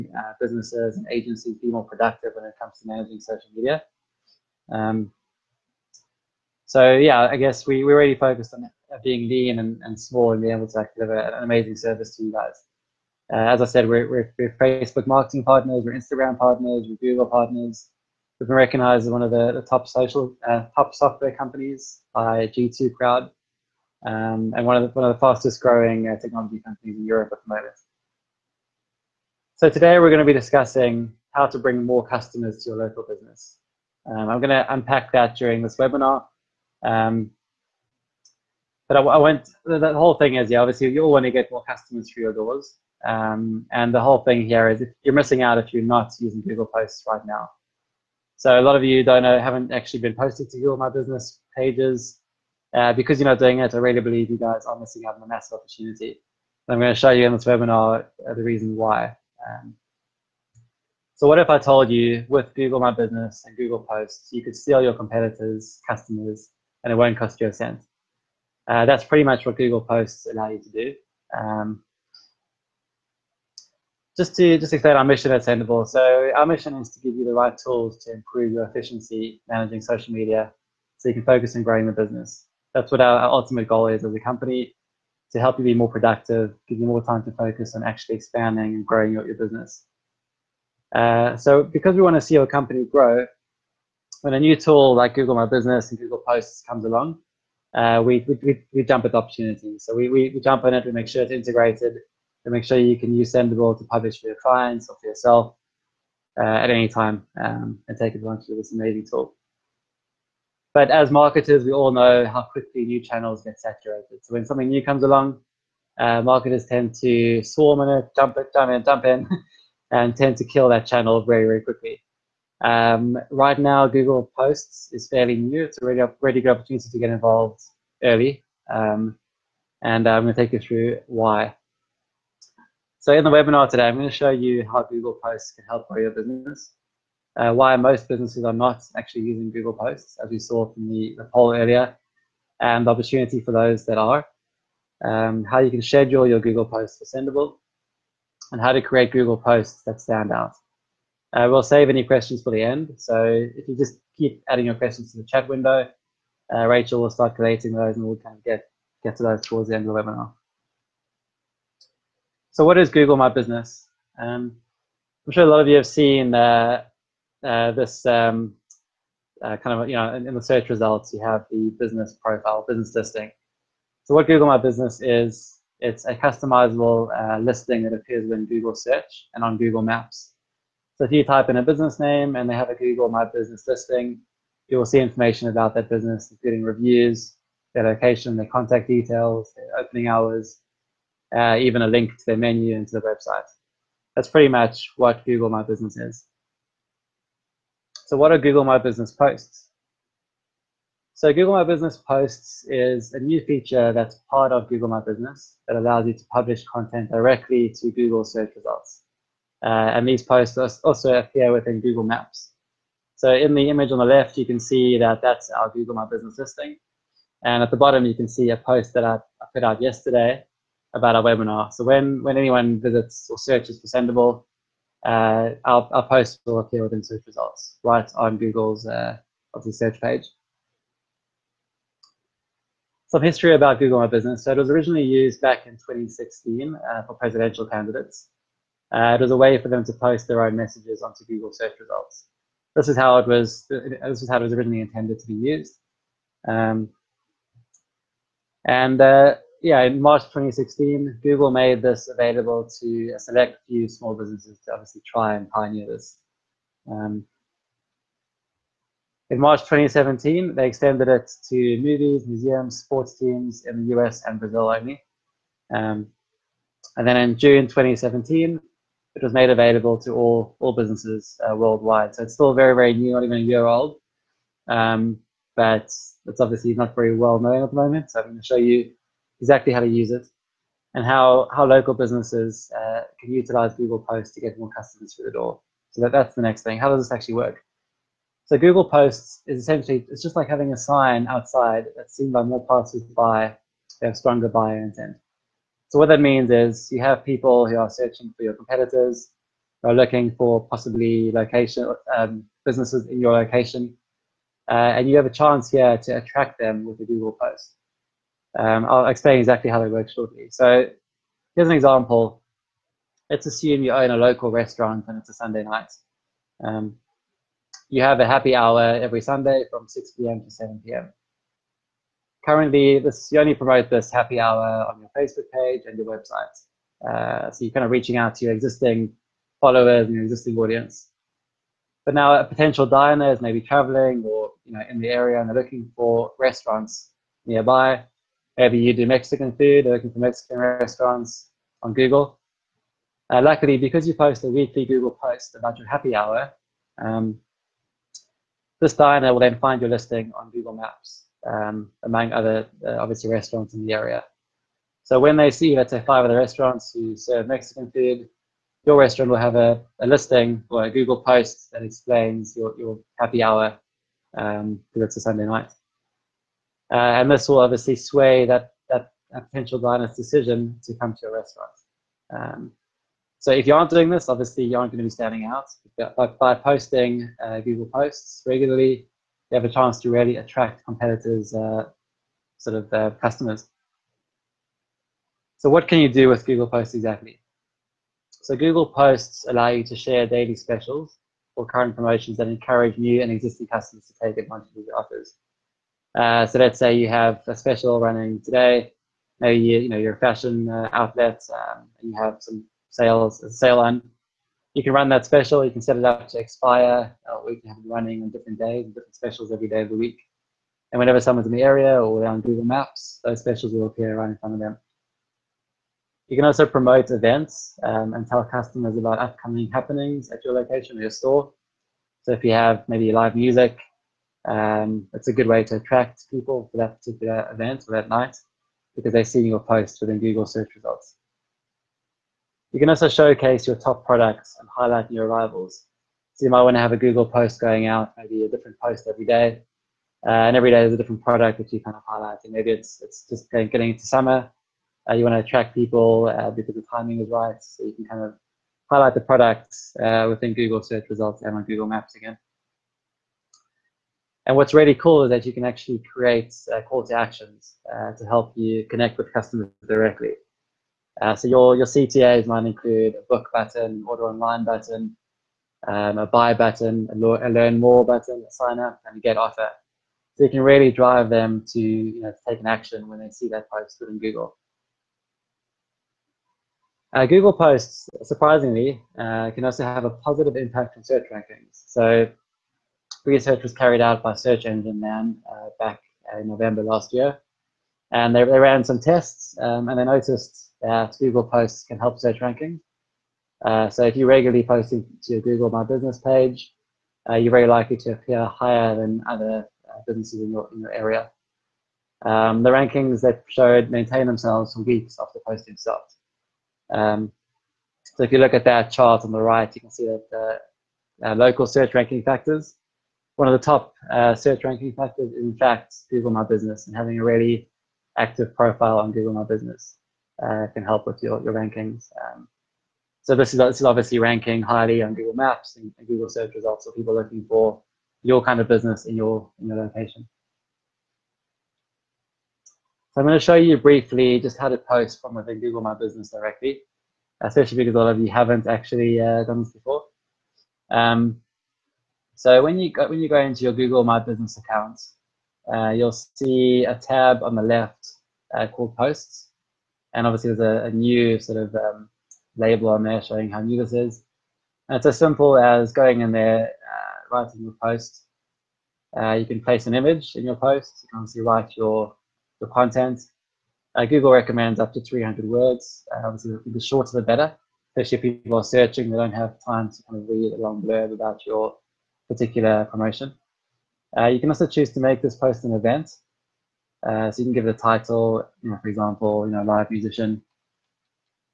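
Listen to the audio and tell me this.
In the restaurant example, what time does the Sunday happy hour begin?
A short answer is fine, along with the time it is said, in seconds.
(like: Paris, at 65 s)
6 p.m., at 319 s.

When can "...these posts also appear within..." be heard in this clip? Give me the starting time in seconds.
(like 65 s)
210 s.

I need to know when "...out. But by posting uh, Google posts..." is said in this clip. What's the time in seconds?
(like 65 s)
375 s.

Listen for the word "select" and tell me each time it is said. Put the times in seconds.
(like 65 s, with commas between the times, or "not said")
253 s.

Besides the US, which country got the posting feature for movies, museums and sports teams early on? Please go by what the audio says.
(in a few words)
Brazil.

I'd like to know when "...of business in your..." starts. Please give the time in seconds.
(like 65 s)
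528 s.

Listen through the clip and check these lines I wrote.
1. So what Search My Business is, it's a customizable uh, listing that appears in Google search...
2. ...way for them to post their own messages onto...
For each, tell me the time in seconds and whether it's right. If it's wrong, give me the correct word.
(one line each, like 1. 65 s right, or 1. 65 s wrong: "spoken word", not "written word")
1. 174 s wrong: "Google", not "Search"
2. 239 s right.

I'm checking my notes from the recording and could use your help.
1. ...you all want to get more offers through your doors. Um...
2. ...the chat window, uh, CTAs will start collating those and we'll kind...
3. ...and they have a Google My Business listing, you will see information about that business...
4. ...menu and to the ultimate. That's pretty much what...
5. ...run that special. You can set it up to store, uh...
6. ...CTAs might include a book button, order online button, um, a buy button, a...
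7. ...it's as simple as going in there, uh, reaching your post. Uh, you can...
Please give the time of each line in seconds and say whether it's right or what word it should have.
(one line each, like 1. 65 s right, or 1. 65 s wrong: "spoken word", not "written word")
1. 40 s wrong: "customers", not "offers"
2. 155 s wrong: "Rachel", not "CTAs"
3. 182 s right
4. 192 s wrong: "website", not "ultimate"
5. 404 s wrong: "expire", not "store"
6. 461 s right
7. 554 s wrong: "writing", not "reaching".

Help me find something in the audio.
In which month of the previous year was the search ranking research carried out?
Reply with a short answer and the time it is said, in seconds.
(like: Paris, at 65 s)
November, at 486 s.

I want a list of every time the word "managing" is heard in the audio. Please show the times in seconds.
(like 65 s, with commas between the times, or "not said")
2 s, 79 s.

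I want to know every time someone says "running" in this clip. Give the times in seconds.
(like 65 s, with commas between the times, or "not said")
397 s, 407 s.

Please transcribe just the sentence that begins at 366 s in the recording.
Uh, and this will obviously sway that, that, that potential diner's decision to come to your restaurant.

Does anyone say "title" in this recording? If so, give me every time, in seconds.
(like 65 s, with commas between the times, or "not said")
577 s.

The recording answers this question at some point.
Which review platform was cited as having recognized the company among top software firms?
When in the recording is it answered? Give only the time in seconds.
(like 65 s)
22 s.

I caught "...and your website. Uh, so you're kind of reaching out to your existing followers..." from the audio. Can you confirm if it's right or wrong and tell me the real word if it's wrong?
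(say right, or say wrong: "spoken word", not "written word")
right.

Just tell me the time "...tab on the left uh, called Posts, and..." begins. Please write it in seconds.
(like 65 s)
546 s.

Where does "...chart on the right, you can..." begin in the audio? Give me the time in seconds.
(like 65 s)
508 s.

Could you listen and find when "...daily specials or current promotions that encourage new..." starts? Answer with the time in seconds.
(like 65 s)
390 s.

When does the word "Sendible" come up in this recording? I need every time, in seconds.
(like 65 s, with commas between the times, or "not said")
75 s, 103 s, 147 s, 223 s.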